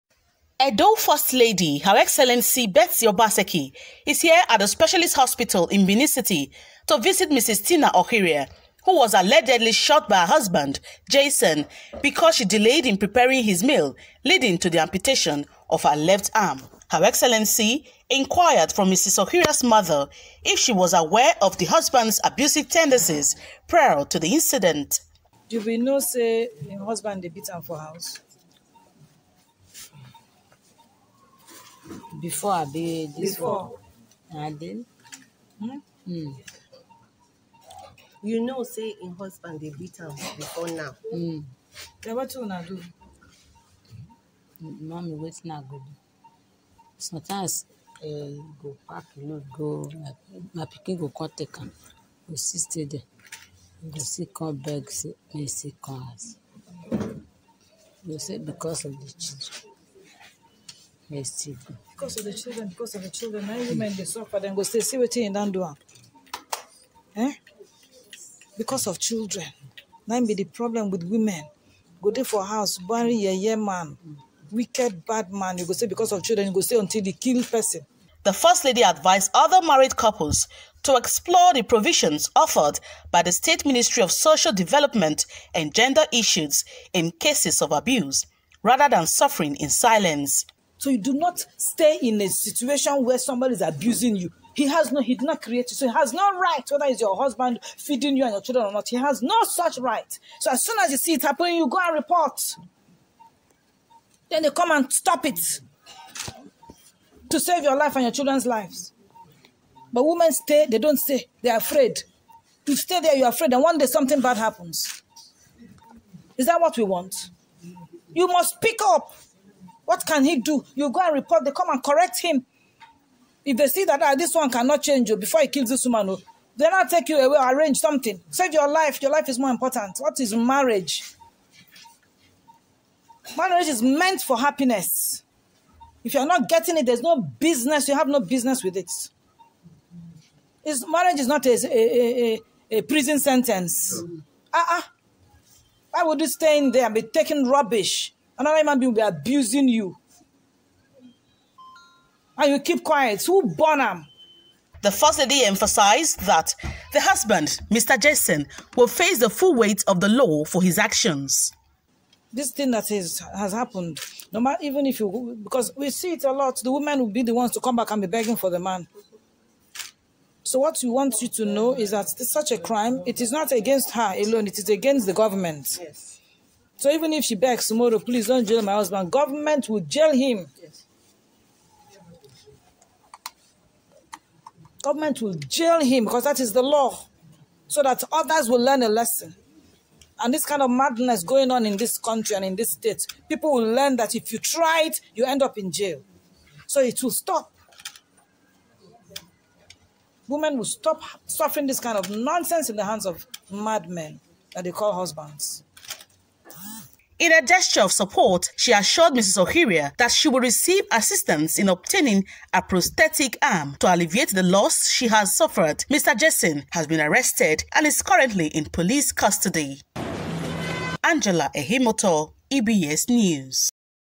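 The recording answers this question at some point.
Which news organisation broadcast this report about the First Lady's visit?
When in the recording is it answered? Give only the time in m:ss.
3:42.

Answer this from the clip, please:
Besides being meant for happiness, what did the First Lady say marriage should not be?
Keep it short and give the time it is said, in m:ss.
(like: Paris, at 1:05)
A prison sentence, at 2:22.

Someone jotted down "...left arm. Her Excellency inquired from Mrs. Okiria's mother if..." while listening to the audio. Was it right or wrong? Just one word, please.
right.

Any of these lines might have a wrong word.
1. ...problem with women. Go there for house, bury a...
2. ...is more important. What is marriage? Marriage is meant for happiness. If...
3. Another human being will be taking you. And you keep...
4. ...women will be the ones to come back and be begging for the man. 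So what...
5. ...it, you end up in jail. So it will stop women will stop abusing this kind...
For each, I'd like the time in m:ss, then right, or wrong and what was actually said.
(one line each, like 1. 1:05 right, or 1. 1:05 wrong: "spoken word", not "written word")
1. 1:10 right
2. 2:09 right
3. 2:28 wrong: "abusing", not "taking"
4. 2:46 right
5. 3:14 wrong: "suffering", not "abusing".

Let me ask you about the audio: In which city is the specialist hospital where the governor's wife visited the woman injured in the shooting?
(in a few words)
Benin City.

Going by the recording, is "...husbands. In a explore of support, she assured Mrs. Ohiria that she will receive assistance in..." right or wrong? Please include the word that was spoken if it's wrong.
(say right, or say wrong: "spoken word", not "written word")
wrong: "gesture", not "explore".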